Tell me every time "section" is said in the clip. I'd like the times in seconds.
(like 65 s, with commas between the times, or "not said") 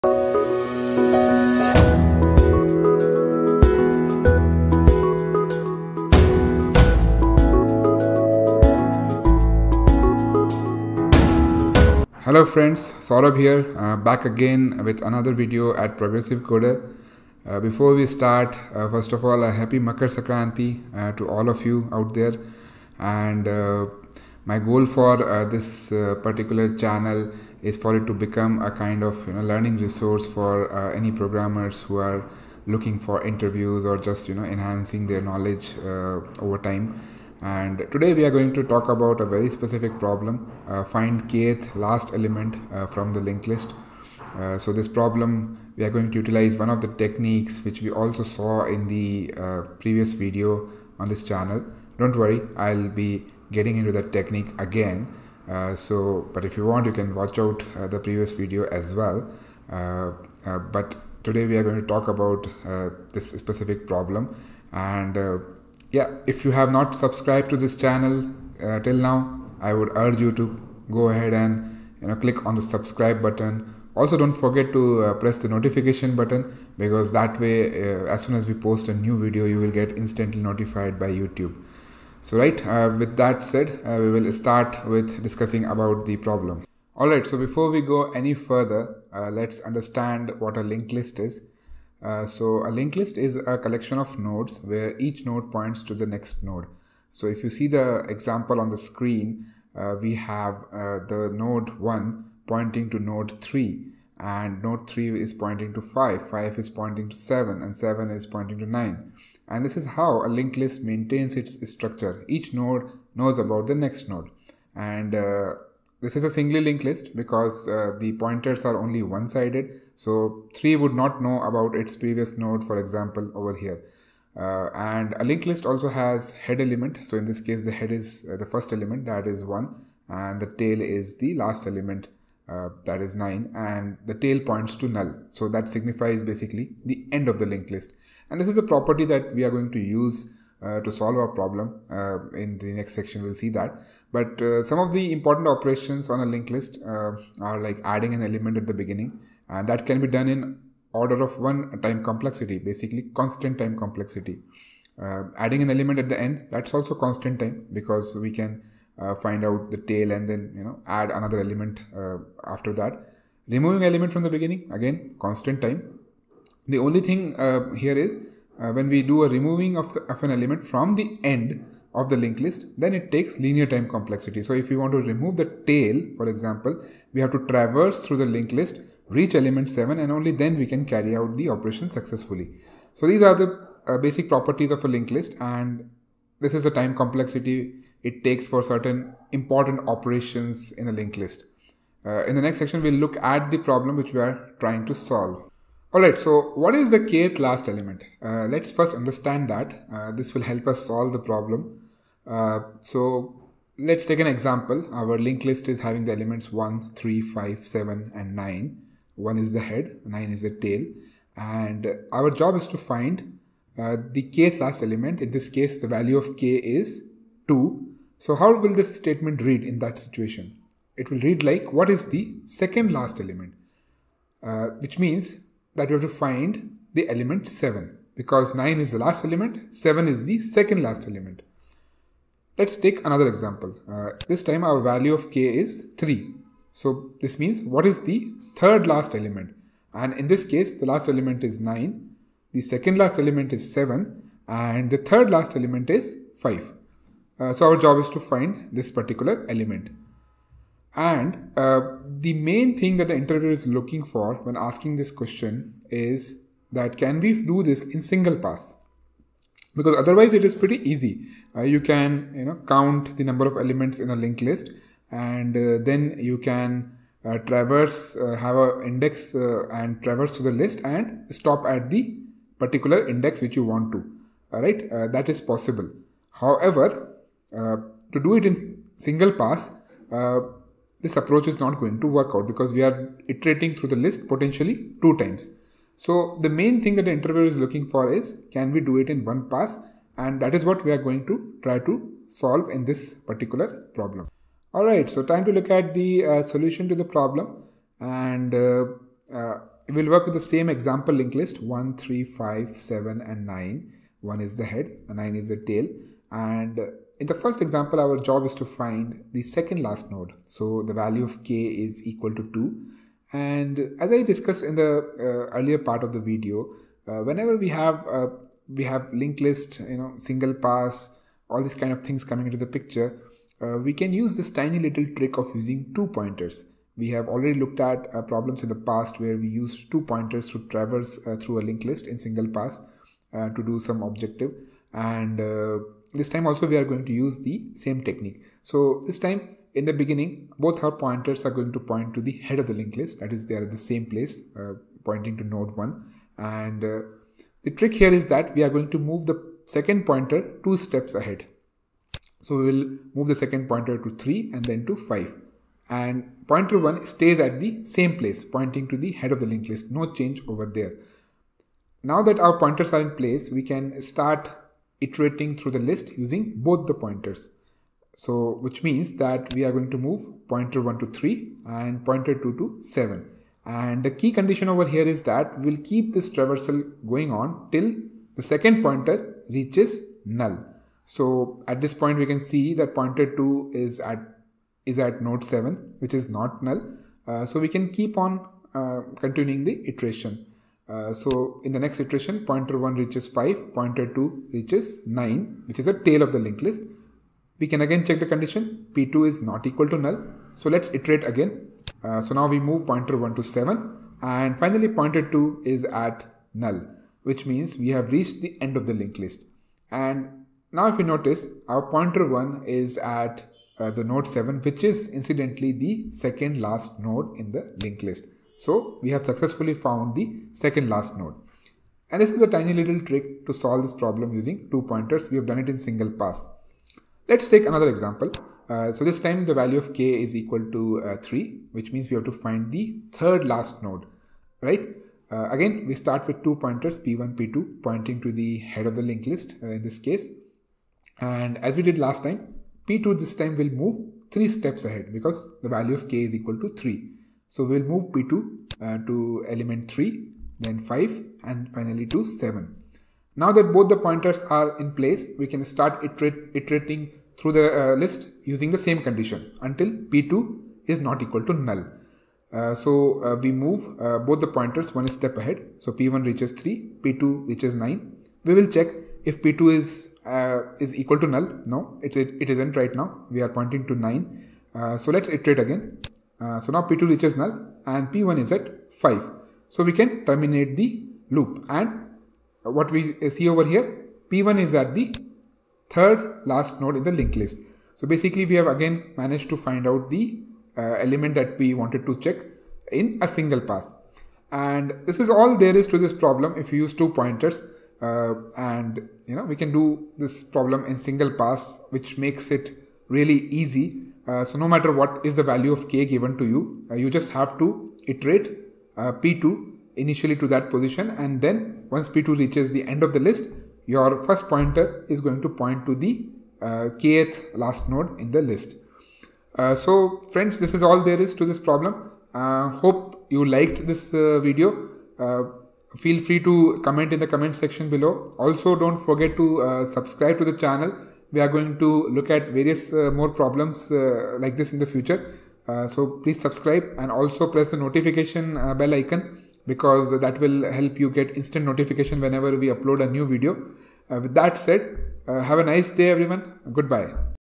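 142 s, 192 s, 527 s.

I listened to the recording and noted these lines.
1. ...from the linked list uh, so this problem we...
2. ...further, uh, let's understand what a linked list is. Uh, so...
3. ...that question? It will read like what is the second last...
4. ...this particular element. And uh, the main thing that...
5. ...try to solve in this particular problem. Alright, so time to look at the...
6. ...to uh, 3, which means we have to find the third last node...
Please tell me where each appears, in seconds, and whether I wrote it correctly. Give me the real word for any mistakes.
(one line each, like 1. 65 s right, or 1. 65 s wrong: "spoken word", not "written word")
1. 42 s right
2. 88 s right
3. 219 s wrong: "situation", not "question"
4. 248 s right
5. 291 s right
6. 430 s right.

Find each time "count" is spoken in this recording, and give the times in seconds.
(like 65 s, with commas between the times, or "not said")
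262 s.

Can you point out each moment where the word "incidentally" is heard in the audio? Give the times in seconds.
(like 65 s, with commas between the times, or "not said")
415 s.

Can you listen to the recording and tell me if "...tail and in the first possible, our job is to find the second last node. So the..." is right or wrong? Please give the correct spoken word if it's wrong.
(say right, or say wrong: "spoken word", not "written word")
wrong: "example", not "possible".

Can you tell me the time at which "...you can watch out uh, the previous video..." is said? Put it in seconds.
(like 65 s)
56 s.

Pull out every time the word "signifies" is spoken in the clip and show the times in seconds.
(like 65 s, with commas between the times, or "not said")
135 s.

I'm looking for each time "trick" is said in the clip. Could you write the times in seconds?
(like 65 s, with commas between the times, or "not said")
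325 s, 347 s, 423 s.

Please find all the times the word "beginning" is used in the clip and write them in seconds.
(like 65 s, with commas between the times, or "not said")
148 s, 164 s, 339 s.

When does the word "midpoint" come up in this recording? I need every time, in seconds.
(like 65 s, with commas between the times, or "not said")
not said.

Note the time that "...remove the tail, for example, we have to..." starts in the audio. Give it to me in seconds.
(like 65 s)
174 s.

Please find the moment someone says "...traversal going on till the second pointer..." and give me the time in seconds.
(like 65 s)
376 s.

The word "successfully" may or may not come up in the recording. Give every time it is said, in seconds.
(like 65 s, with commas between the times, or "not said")
181 s, 419 s.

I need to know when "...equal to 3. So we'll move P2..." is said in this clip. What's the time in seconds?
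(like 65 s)
446 s.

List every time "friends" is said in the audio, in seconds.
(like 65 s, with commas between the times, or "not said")
12 s, 520 s.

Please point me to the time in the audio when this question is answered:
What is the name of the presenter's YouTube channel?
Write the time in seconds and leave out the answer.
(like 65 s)
15 s.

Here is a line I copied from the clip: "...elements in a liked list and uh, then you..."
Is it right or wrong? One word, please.
wrong.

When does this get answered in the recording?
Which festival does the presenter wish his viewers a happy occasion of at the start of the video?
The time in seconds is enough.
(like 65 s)
19 s.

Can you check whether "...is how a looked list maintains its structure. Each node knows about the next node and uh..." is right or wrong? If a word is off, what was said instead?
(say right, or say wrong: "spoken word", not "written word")
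wrong: "linked", not "looked".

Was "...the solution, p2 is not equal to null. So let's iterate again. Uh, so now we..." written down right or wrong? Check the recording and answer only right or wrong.
wrong.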